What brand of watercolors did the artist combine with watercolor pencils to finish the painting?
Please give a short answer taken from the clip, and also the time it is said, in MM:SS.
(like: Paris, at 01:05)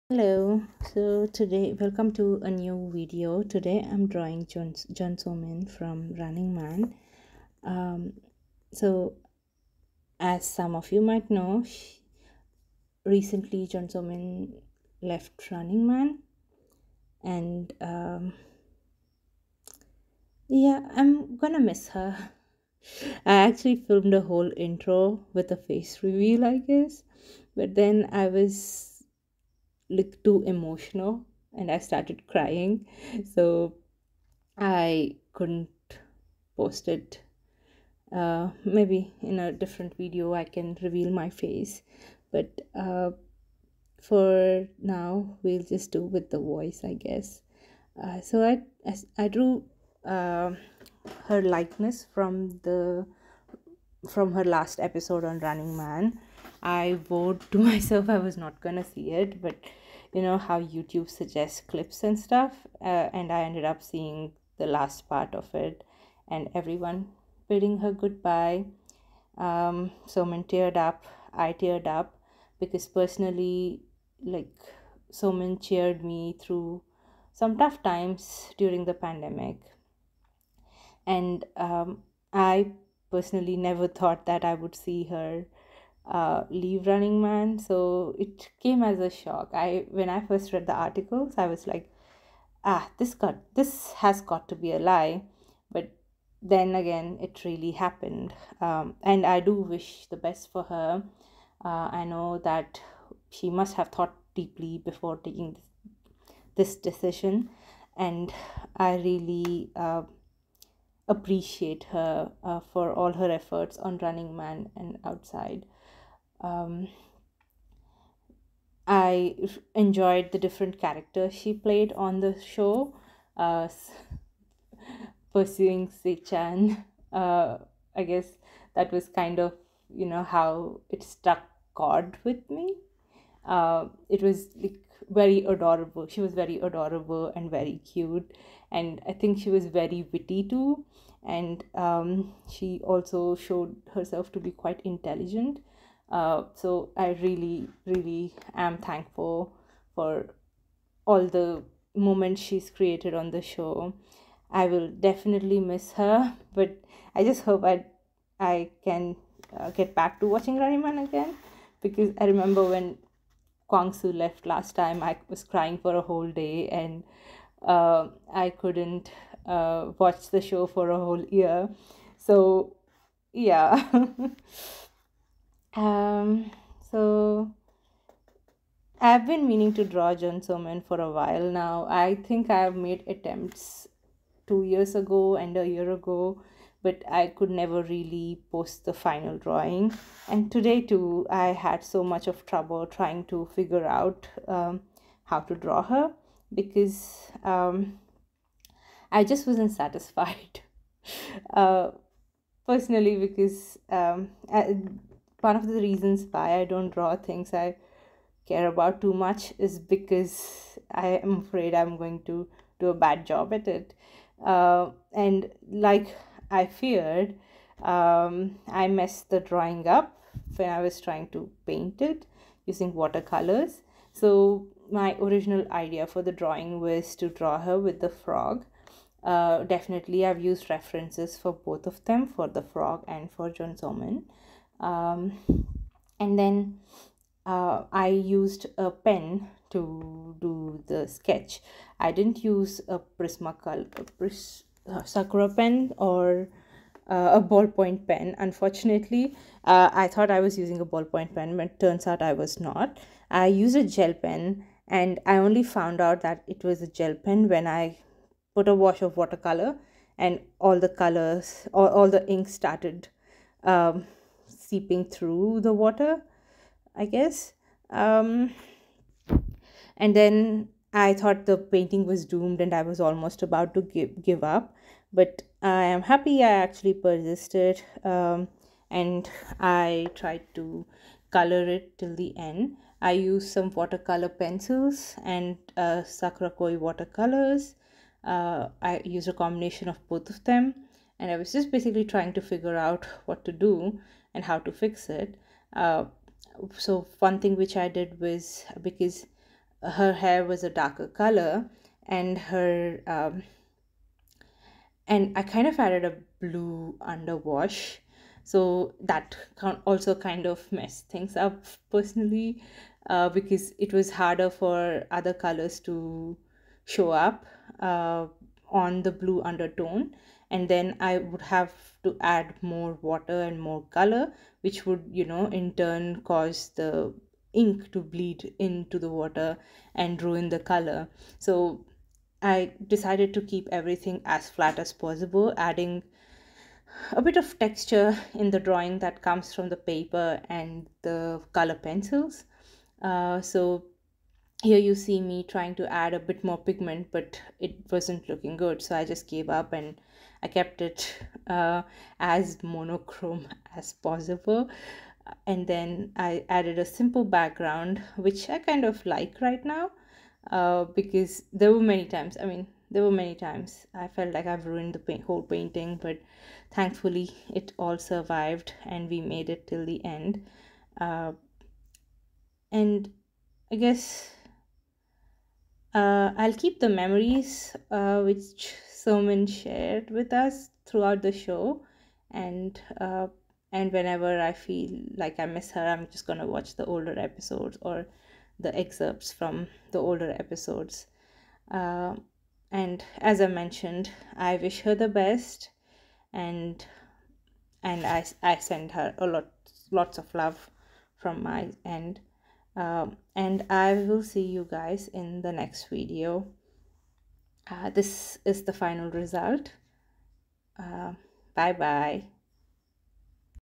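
Koi, at 04:46.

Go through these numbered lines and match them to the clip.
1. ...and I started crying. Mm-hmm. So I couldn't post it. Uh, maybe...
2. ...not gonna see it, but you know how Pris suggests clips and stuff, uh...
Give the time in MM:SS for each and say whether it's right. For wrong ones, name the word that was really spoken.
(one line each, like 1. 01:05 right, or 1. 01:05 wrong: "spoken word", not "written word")
1. 00:31 right
2. 00:58 wrong: "YouTube", not "Pris".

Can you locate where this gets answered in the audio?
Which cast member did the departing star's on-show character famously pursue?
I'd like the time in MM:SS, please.
02:05.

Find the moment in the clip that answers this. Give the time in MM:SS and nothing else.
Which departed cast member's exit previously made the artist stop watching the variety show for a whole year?
02:43.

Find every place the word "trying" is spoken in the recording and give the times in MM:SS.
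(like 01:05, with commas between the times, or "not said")
03:12, 03:41, 04:52, 05:45.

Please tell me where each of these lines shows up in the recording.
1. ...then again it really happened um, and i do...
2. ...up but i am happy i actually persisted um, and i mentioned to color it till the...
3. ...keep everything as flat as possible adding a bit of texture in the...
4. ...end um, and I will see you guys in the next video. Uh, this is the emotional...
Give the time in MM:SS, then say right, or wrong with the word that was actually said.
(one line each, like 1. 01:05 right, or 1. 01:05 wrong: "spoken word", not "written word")
1. 01:36 right
2. 04:34 wrong: "tried", not "mentioned"
3. 05:33 right
4. 06:41 wrong: "final", not "emotional".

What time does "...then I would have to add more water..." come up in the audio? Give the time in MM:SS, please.
05:20.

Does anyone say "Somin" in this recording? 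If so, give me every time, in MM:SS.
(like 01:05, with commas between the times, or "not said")
00:05, 00:13, 01:10, 01:15, 03:00, 03:53, 06:18.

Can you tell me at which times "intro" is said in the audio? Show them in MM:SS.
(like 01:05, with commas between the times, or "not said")
00:24.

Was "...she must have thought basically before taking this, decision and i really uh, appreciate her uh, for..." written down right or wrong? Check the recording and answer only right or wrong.
wrong.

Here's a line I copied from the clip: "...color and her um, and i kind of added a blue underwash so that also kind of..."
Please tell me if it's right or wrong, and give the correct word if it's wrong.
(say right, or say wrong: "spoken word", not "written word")
right.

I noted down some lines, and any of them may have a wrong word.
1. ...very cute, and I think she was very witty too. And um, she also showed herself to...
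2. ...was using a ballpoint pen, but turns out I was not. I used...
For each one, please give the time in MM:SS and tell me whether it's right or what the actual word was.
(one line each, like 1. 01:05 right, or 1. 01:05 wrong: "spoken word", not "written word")
1. 02:17 right
2. 04:10 right.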